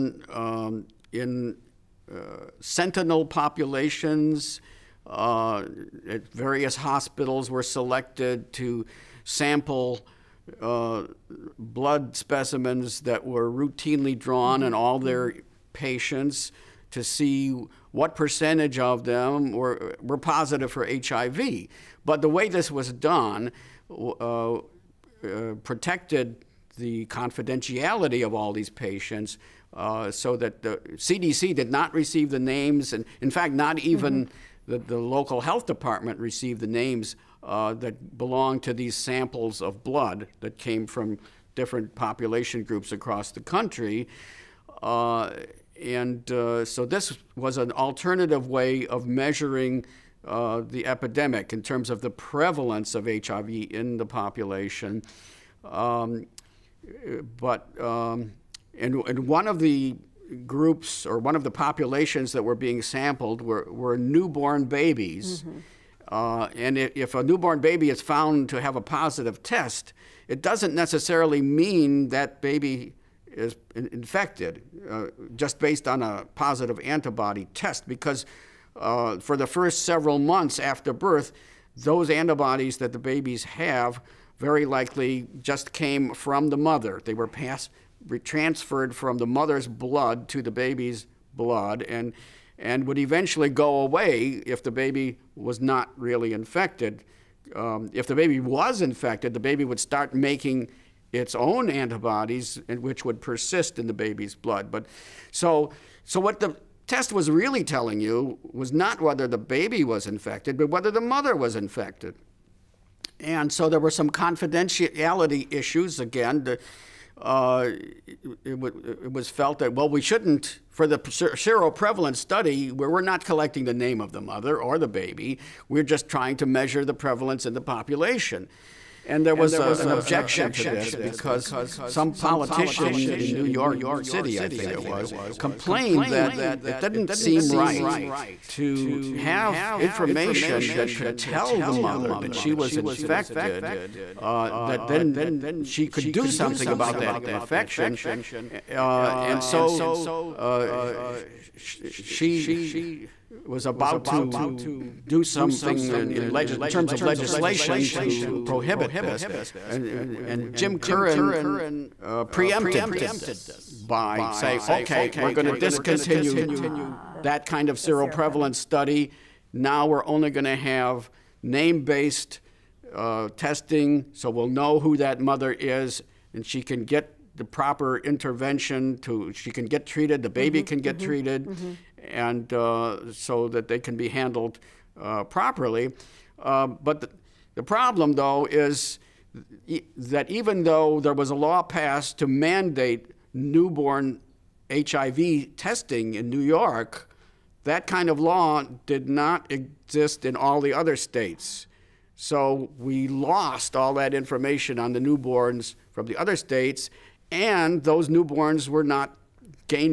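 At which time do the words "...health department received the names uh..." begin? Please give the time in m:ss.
0:35.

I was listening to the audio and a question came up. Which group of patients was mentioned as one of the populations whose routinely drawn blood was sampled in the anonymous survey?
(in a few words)
Newborn babies.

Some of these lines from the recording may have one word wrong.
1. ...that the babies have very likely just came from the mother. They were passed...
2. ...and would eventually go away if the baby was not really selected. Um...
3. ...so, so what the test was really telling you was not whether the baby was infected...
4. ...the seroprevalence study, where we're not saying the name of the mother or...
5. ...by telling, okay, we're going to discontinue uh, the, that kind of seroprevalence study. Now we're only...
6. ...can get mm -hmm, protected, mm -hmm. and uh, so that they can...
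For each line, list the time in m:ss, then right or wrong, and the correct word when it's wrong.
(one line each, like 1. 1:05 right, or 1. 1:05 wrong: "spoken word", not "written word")
1. 1:22 right
2. 1:32 wrong: "infected", not "selected"
3. 1:45 right
4. 2:00 wrong: "collecting", not "saying"
5. 2:43 wrong: "saying", not "telling"
6. 3:00 wrong: "treated", not "protected".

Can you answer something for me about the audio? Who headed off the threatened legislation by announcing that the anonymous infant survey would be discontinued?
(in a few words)
Jim Curran.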